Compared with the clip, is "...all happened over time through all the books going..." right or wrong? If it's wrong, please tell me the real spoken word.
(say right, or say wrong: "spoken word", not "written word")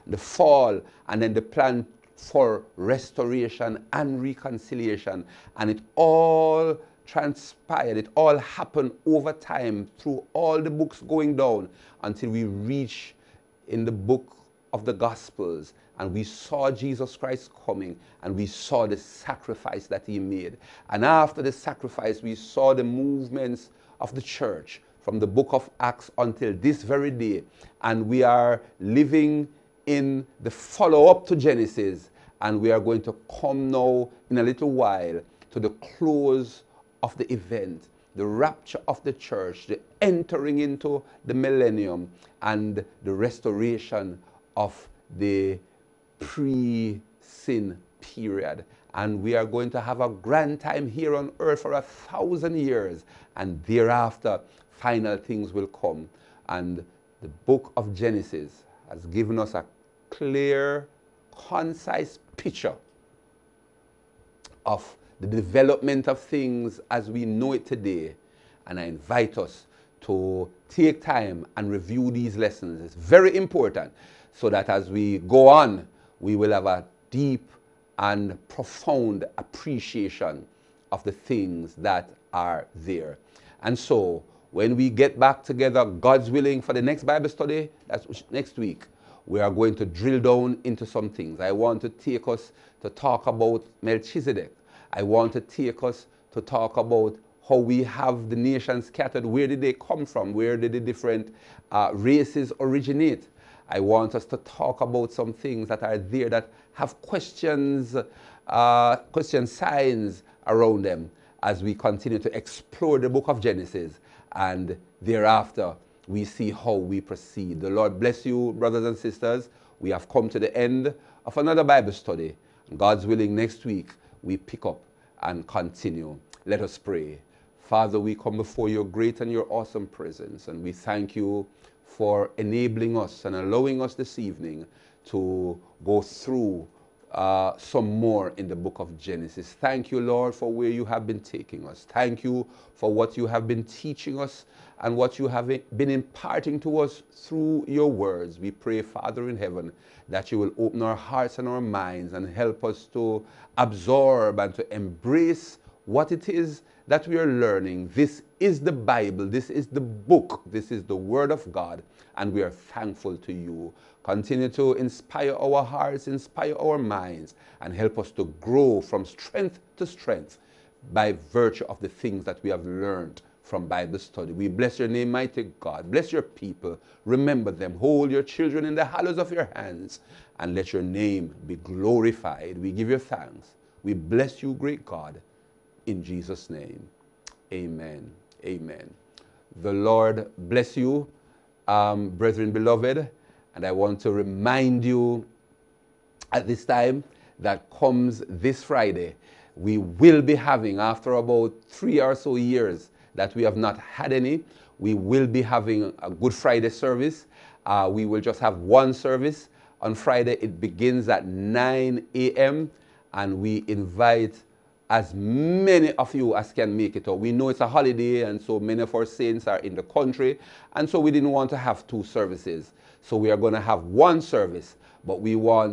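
right.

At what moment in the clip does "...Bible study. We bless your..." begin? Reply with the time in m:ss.
2:53.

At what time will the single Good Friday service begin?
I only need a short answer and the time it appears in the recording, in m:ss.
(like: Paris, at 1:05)
9 a.m., at 3:31.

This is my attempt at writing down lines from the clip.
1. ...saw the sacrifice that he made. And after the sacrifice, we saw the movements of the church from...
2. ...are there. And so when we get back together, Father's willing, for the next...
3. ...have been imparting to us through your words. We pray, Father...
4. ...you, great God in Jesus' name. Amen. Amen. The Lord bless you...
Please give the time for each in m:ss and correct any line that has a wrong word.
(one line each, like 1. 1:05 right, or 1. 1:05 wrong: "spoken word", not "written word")
1. 0:18 right
2. 1:22 wrong: "God", not "Father"
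3. 2:25 right
4. 3:04 right.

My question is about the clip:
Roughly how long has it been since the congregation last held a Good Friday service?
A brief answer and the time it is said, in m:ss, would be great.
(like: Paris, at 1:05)
3 years, at 3:21.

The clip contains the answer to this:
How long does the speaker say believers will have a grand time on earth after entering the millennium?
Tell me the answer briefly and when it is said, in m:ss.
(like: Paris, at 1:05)
1000 years, at 0:51.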